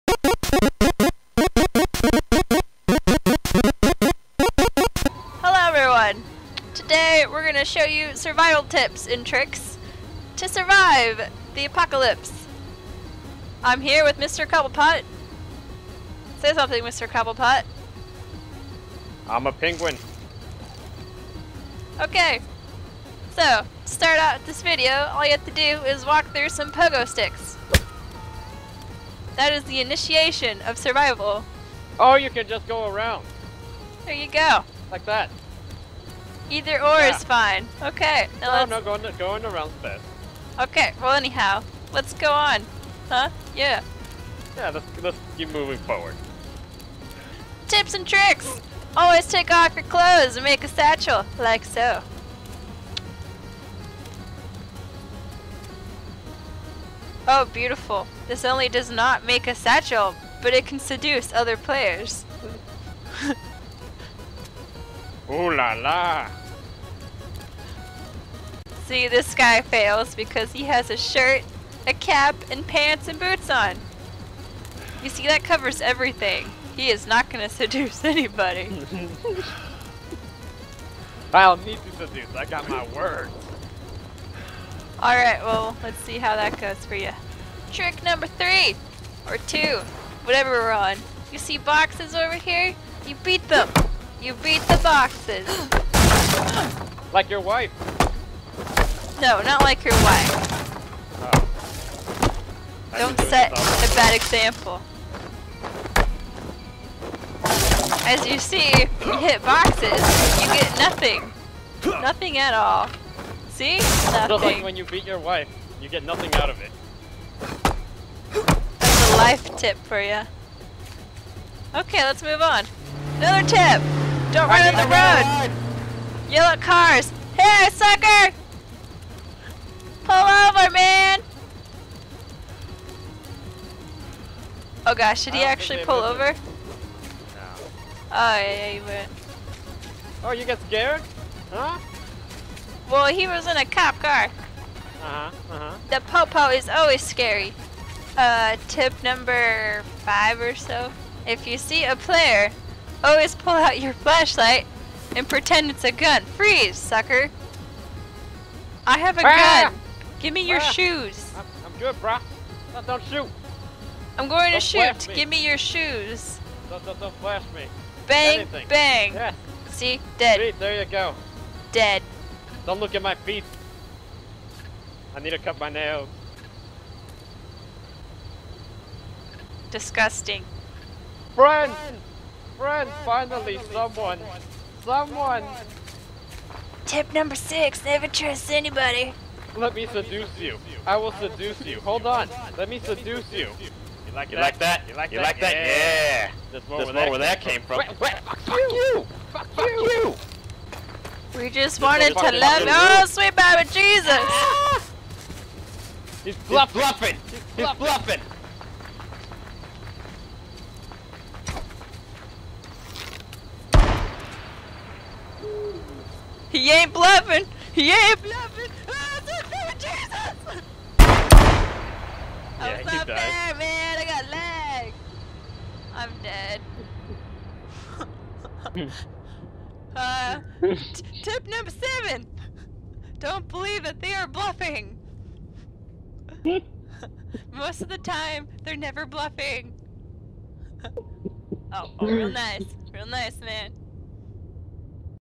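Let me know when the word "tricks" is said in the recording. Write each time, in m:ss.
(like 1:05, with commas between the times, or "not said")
0:09, 0:48, 1:27.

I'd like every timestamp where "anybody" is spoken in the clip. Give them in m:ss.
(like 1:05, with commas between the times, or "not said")
1:18, 3:08.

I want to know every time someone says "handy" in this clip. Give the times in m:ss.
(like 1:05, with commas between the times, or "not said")
not said.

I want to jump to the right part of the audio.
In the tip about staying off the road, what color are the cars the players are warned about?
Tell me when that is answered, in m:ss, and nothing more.
2:06.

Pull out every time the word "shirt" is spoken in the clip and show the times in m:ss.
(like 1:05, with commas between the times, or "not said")
1:10.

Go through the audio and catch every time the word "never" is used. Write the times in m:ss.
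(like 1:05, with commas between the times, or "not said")
3:07, 3:58.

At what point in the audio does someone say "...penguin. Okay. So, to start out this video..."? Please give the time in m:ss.
0:19.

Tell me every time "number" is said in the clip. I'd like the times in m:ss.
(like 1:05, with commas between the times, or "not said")
1:28, 2:29, 3:07, 3:51.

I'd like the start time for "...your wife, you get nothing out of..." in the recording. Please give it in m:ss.
1:55.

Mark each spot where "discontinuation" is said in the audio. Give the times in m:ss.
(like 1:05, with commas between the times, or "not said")
not said.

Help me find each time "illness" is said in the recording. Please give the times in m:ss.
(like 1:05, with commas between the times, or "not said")
not said.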